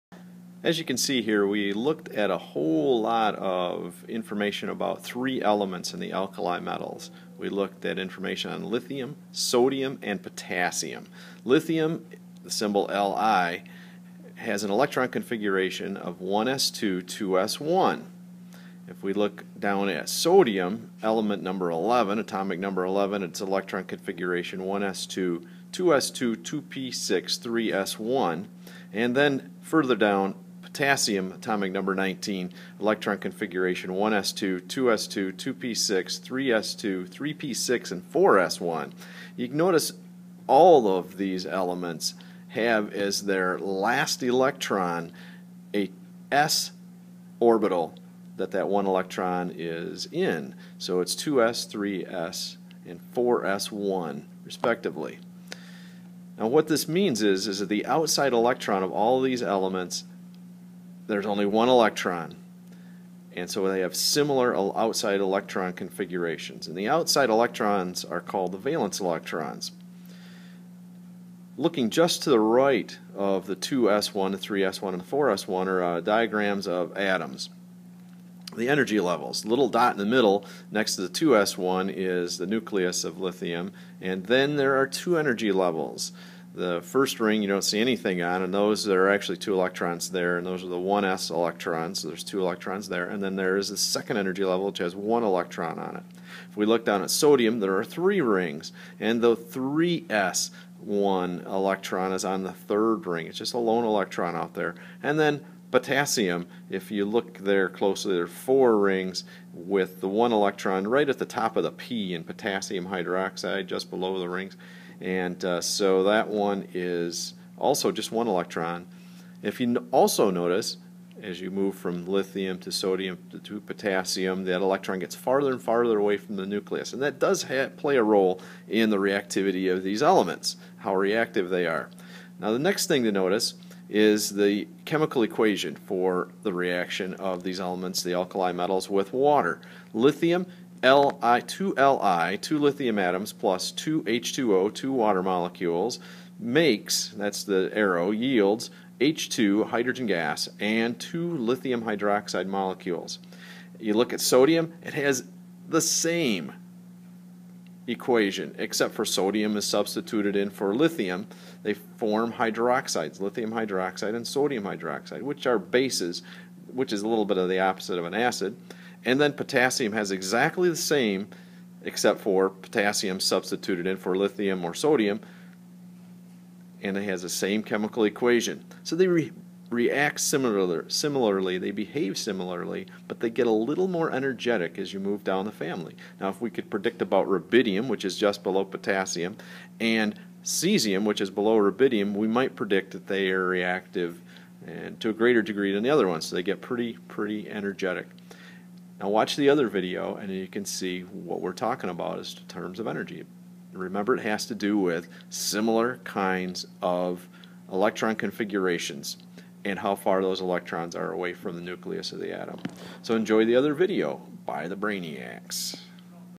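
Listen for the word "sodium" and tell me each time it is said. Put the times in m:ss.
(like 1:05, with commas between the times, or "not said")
0:09, 0:20, 1:37, 2:02, 2:34, 2:39, 2:44, 2:54.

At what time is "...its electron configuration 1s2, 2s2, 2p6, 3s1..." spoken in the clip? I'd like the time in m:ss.
0:23.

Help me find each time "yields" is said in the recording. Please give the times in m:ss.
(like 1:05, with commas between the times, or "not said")
2:28.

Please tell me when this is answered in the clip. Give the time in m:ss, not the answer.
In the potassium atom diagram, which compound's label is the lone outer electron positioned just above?
1:52.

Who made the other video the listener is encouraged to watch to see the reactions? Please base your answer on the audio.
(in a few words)
the Brainiacs.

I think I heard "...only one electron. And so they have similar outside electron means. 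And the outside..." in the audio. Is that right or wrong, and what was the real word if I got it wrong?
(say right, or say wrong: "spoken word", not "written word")
wrong: "configurations", not "means".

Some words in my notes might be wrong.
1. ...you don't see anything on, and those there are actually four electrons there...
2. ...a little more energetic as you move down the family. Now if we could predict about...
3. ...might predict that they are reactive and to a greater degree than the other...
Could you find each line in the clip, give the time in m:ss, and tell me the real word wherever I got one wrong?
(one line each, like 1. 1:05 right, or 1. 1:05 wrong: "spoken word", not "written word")
1. 1:27 wrong: "two", not "four"
2. 3:03 right
3. 3:12 right.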